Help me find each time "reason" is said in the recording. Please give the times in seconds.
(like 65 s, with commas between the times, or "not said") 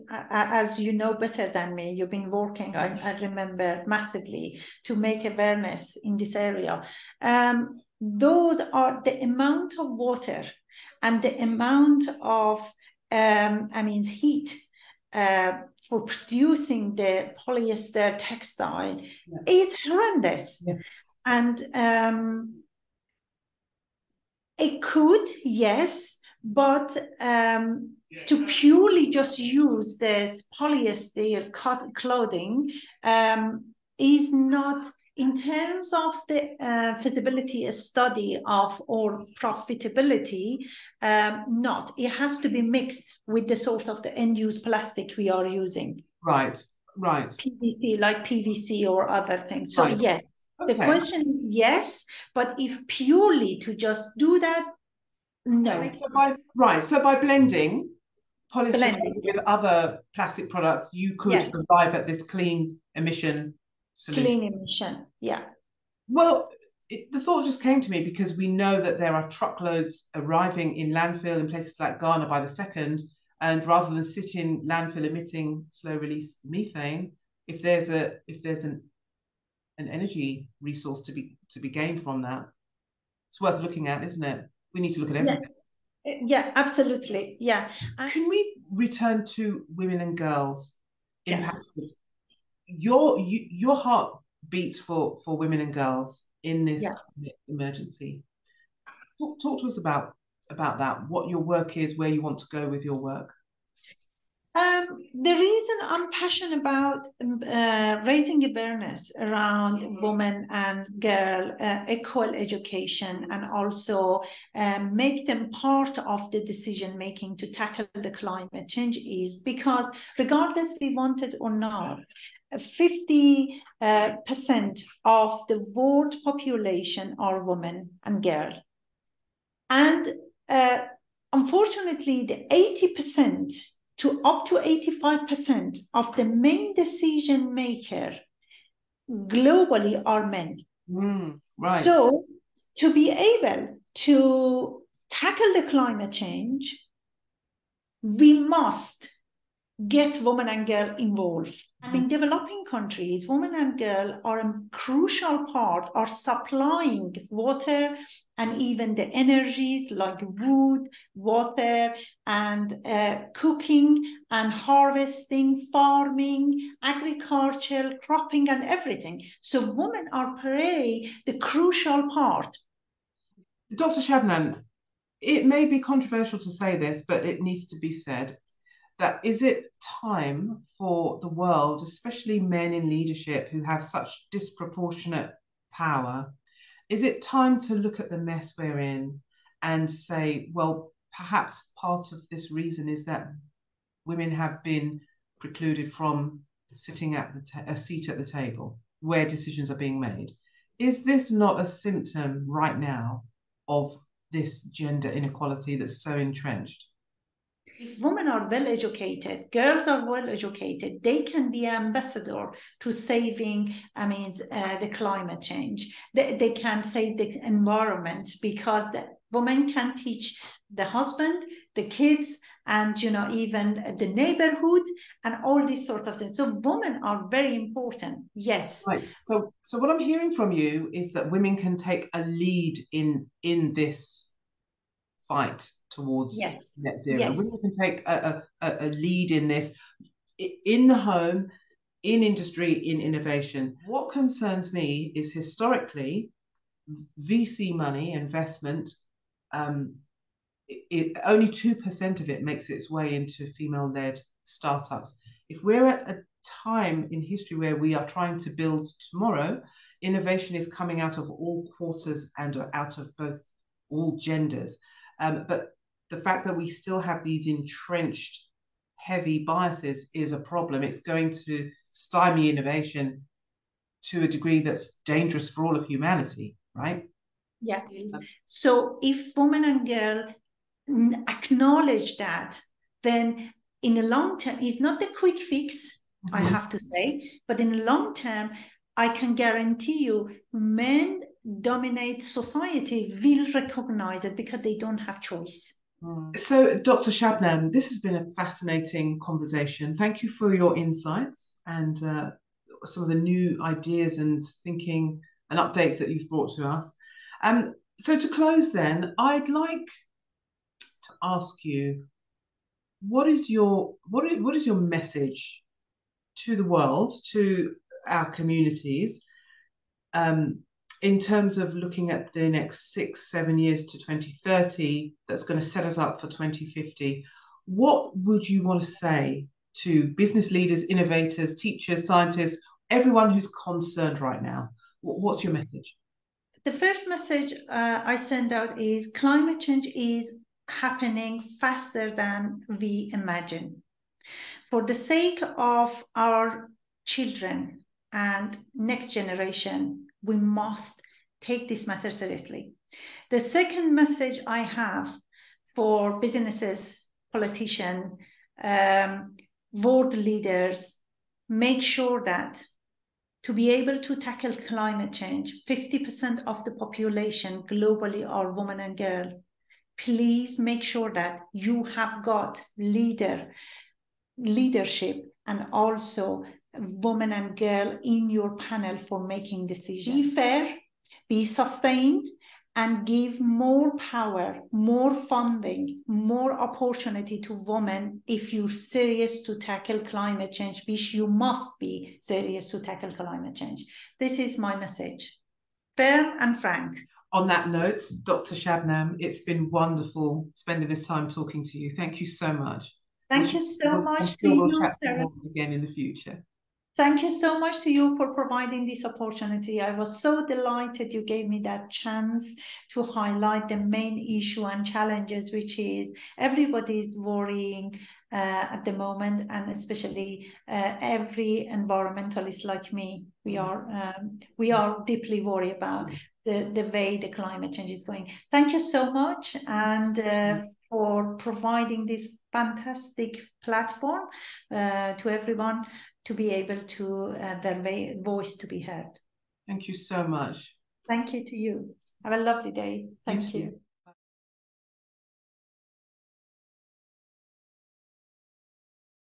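105 s, 192 s.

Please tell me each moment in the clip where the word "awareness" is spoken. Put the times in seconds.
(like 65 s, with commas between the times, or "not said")
5 s, 108 s.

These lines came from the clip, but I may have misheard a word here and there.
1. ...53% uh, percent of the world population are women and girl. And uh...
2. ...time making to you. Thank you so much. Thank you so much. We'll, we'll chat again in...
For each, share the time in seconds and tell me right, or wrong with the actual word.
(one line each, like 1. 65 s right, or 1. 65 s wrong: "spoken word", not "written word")
1. 122 s wrong: "50", not "53"
2. 401 s wrong: "talking", not "making".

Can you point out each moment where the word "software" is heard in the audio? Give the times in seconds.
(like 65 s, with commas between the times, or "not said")
not said.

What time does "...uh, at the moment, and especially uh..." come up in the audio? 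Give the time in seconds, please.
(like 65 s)
418 s.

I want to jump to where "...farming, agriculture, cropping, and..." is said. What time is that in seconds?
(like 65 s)
165 s.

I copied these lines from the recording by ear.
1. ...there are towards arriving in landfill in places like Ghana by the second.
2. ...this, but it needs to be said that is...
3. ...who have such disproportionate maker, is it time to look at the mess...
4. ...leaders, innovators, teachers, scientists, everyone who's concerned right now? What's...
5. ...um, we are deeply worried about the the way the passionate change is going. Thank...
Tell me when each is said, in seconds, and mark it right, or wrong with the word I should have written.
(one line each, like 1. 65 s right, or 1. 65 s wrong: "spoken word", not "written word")
1. 68 s wrong: "truckloads", not "towards"
2. 176 s right
3. 183 s wrong: "power", not "maker"
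4. 330 s right
5. 424 s wrong: "climate", not "passionate".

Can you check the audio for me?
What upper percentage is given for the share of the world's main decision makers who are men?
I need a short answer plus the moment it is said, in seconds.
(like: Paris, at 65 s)
85%, at 134 s.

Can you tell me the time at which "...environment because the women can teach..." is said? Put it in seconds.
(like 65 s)
217 s.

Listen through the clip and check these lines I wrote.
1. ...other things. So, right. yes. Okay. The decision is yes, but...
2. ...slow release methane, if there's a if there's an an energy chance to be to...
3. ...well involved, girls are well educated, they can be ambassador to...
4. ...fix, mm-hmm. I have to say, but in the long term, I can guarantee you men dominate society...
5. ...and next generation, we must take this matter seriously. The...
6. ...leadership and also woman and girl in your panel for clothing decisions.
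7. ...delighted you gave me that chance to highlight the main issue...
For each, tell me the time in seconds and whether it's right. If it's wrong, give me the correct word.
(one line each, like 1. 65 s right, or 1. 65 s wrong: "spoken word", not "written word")
1. 49 s wrong: "question", not "decision"
2. 75 s wrong: "resource", not "chance"
3. 208 s wrong: "educated", not "involved"
4. 285 s right
5. 348 s right
6. 374 s wrong: "making", not "clothing"
7. 410 s right.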